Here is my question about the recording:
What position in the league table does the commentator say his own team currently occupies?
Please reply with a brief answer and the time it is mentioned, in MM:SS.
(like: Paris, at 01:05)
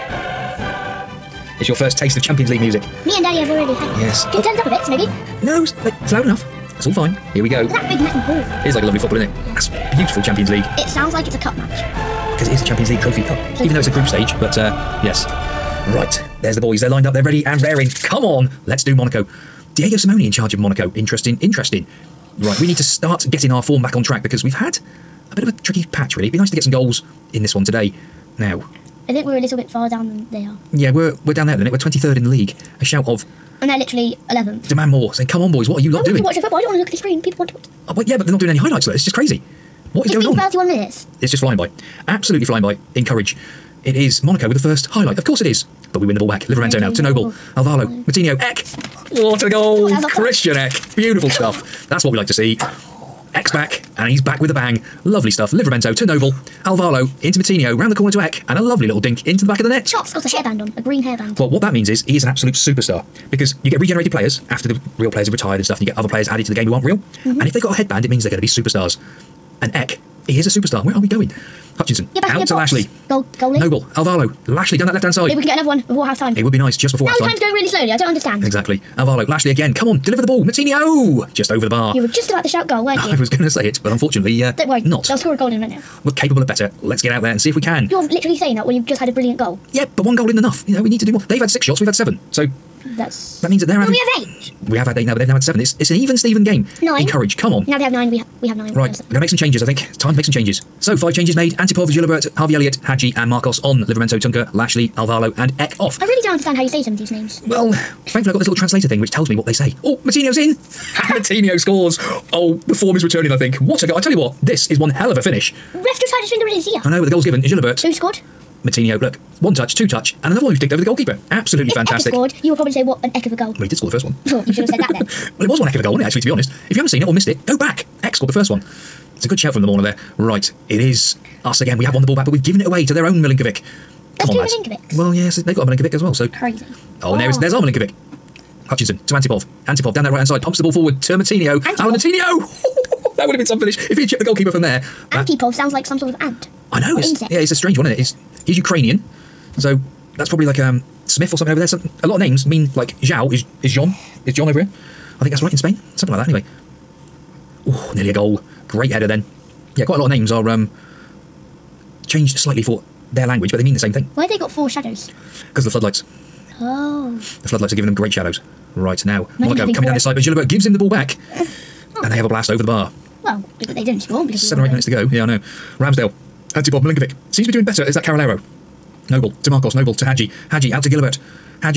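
23rd, at 00:31.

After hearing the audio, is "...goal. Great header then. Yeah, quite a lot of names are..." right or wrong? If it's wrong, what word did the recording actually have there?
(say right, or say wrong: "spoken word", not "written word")
right.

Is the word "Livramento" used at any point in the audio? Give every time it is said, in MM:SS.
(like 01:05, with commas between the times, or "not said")
00:46, 00:55, 01:43.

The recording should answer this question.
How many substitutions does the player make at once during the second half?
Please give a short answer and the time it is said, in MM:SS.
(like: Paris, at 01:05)
5, at 01:40.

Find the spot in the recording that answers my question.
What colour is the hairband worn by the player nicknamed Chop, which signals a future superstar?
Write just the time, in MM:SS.
01:00.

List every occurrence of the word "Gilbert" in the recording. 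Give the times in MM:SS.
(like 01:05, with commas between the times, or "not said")
01:41, 01:57, 03:00.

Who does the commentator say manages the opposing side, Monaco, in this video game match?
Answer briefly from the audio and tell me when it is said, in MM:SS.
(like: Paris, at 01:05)
Diego Simeone, at 00:19.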